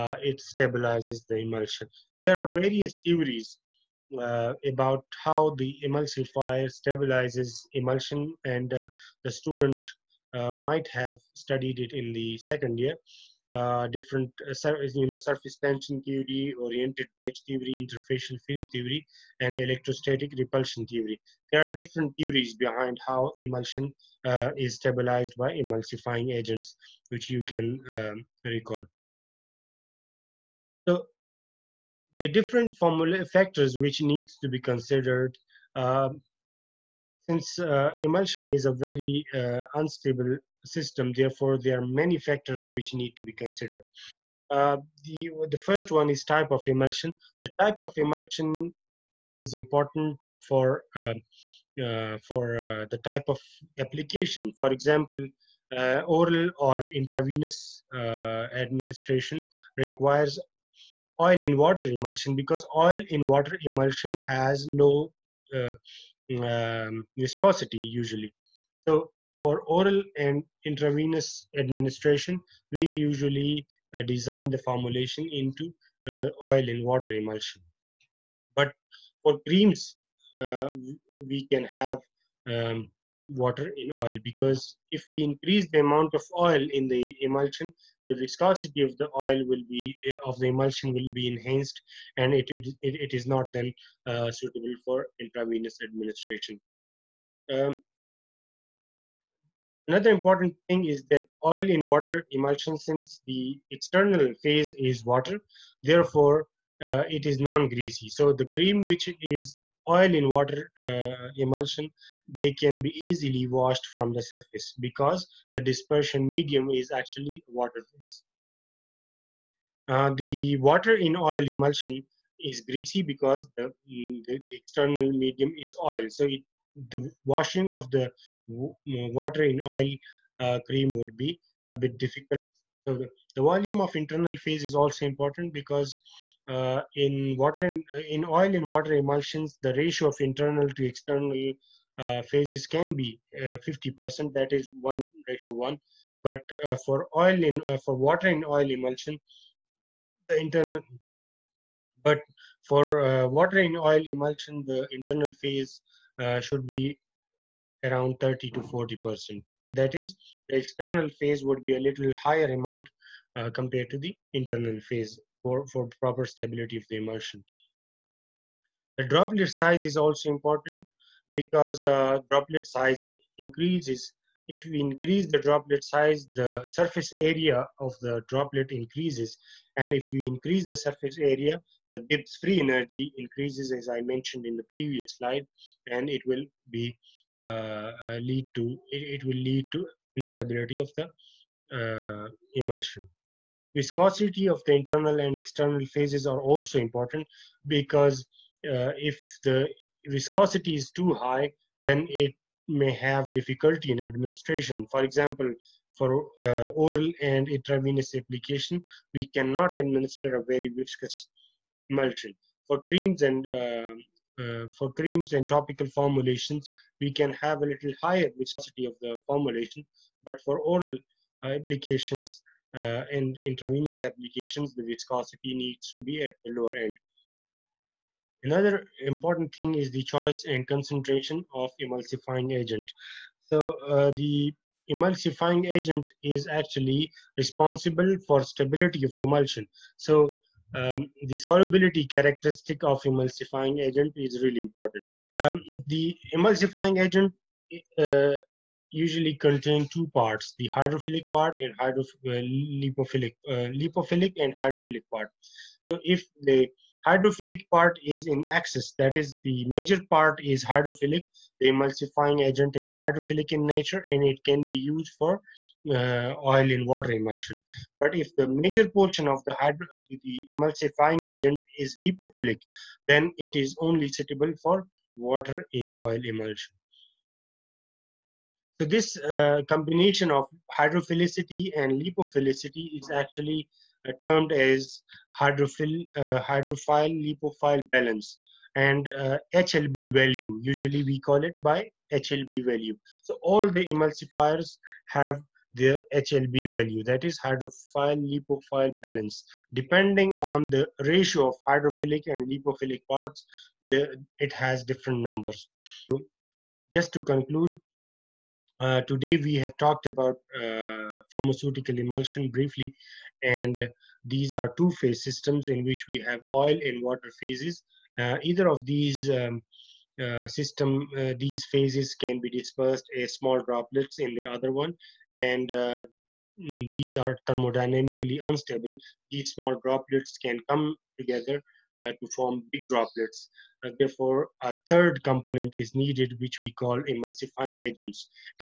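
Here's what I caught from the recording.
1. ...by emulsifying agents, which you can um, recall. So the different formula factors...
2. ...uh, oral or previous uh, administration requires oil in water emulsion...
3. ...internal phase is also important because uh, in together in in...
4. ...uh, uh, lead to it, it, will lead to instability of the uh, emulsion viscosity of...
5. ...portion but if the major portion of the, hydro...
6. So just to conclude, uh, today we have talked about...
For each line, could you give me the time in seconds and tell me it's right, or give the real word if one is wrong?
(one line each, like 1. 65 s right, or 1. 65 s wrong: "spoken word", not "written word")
1. 25 s right
2. 55 s wrong: "intravenous", not "previous"
3. 133 s wrong: "water", not "together"
4. 187 s right
5. 267 s wrong: "emulsion", not "portion"
6. 306 s right.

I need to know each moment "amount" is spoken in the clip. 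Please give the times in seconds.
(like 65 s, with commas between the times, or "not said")
85 s, 162 s.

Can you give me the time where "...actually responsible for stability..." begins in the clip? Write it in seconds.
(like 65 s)
236 s.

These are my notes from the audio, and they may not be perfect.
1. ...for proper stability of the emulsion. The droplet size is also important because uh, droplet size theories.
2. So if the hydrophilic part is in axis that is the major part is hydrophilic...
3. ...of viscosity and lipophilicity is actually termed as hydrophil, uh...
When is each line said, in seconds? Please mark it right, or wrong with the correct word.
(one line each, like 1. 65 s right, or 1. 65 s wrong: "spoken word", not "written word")
1. 165 s wrong: "increases", not "theories"
2. 255 s right
3. 280 s wrong: "hydrophilicity", not "viscosity".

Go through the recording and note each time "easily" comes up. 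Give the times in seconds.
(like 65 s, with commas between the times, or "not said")
112 s.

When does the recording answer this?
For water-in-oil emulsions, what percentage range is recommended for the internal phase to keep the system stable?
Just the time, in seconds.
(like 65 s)
158 s.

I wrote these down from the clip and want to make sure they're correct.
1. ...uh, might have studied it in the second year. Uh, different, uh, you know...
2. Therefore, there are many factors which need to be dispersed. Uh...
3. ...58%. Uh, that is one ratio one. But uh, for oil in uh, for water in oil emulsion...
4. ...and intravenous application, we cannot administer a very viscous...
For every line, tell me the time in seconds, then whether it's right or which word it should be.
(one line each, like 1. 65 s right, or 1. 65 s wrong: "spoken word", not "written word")
1. 10 s right
2. 41 s wrong: "considered", not "dispersed"
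3. 143 s wrong: "50", not "58"
4. 207 s right.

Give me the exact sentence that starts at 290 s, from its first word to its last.
Usually we call it by HLB value.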